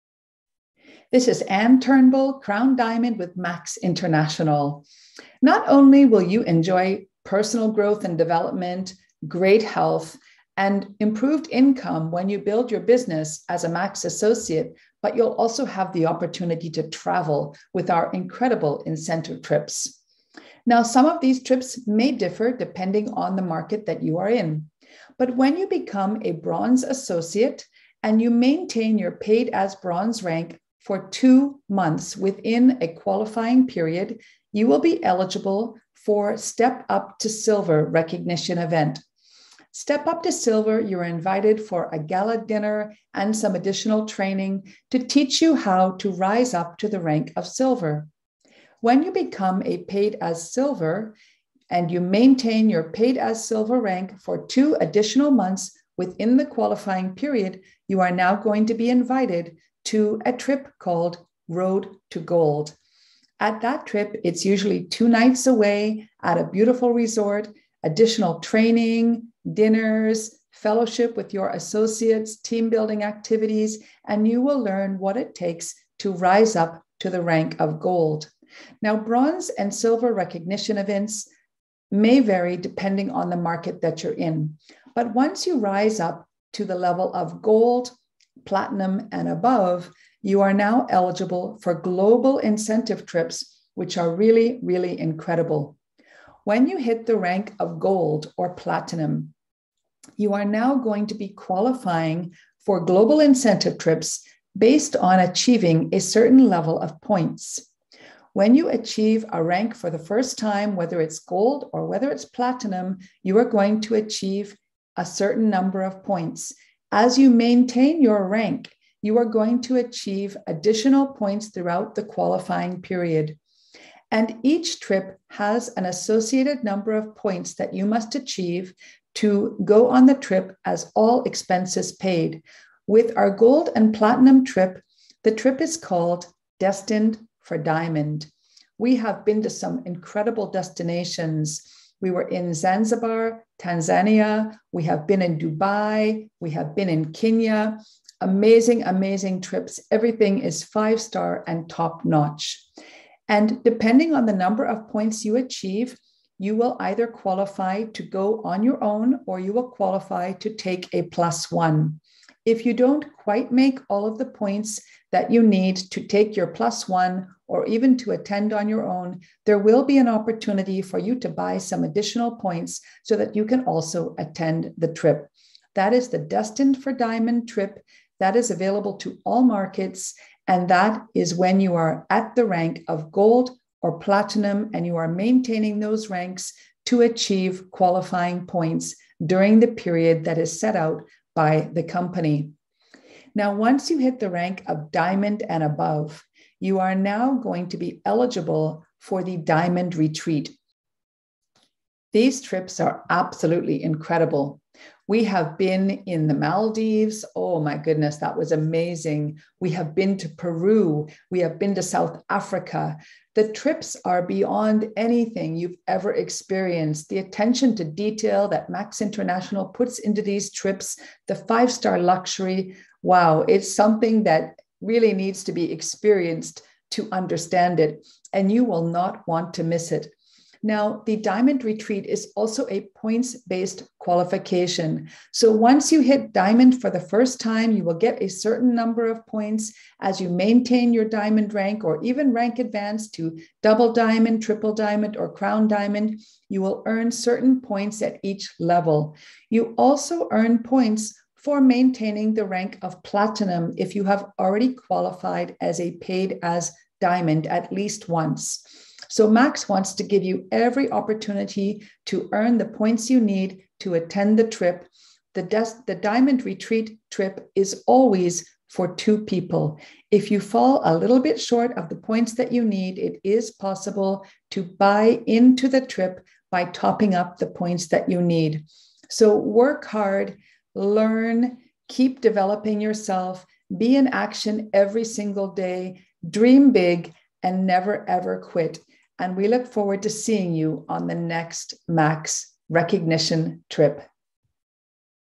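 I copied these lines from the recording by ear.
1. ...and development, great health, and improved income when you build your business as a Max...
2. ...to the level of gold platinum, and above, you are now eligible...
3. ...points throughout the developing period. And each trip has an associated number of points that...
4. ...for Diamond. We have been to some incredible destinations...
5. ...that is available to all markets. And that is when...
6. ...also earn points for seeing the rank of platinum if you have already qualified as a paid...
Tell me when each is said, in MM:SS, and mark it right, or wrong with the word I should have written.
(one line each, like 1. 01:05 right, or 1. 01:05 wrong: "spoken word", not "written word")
1. 00:08 right
2. 01:26 right
3. 02:01 wrong: "qualifying", not "developing"
4. 02:17 right
5. 02:58 right
6. 04:09 wrong: "maintaining", not "seeing".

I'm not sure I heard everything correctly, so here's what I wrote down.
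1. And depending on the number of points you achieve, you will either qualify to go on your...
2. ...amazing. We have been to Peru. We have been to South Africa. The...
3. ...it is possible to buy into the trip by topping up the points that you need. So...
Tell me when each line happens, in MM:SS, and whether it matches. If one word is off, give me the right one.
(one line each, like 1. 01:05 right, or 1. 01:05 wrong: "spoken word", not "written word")
1. 02:33 right
2. 03:28 right
3. 04:32 right.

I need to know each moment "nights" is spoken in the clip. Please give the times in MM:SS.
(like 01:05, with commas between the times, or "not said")
01:05.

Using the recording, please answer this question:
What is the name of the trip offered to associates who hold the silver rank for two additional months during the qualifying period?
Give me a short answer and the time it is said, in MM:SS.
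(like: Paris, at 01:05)
Road to Gold, at 01:01.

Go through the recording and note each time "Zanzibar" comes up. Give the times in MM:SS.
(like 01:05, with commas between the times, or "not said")
02:22.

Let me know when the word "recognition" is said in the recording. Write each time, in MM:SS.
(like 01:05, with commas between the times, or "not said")
00:37, 01:20, 04:52.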